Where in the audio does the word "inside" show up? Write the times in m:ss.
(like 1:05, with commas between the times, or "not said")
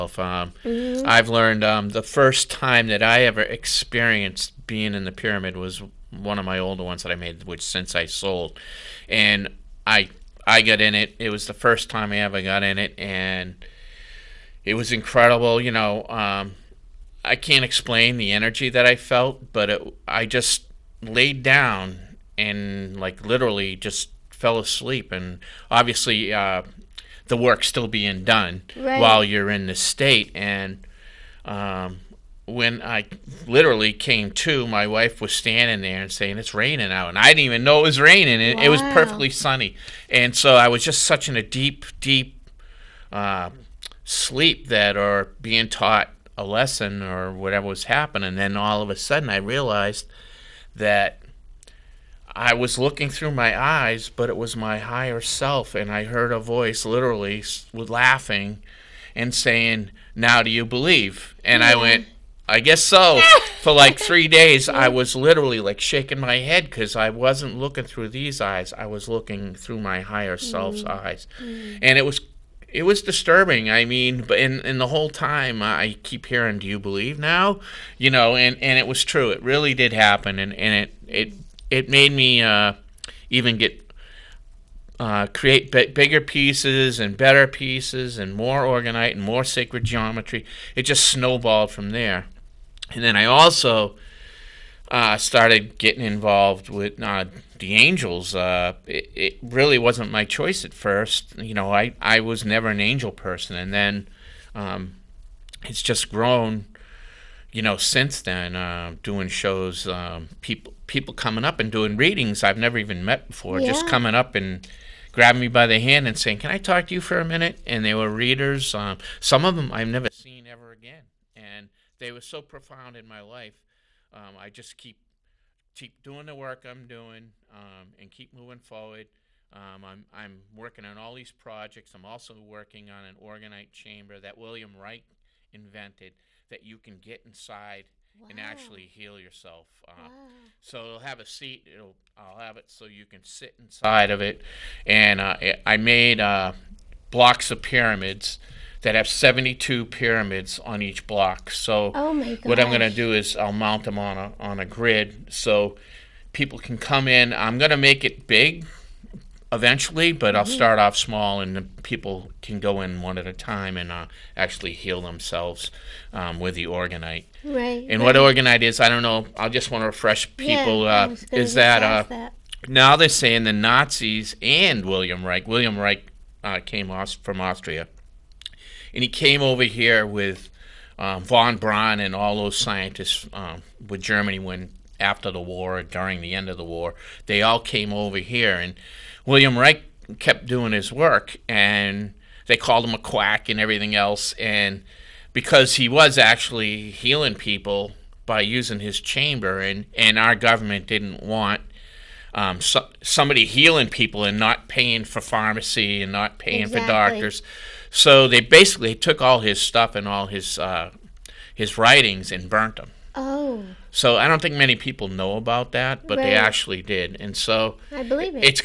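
2:17, 2:23.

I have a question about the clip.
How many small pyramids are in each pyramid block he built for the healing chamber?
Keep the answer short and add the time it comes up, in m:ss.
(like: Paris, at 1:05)
72, at 2:29.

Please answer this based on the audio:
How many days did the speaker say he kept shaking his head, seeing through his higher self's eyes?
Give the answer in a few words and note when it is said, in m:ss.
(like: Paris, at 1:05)
3, at 1:03.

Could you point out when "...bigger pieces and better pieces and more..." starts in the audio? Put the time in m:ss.
1:25.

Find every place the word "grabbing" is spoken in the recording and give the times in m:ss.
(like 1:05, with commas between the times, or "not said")
1:55.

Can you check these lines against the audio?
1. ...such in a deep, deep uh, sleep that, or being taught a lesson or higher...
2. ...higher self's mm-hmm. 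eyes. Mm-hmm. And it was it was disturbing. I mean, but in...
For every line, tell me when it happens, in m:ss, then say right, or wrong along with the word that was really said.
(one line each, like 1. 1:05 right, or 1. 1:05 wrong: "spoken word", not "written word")
1. 0:41 wrong: "whatever", not "higher"
2. 1:10 right.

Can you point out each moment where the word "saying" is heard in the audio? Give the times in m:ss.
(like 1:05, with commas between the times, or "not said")
0:36, 0:59, 1:56, 2:53.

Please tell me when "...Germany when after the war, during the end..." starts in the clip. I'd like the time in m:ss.
3:04.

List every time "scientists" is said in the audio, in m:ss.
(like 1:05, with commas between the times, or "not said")
3:02.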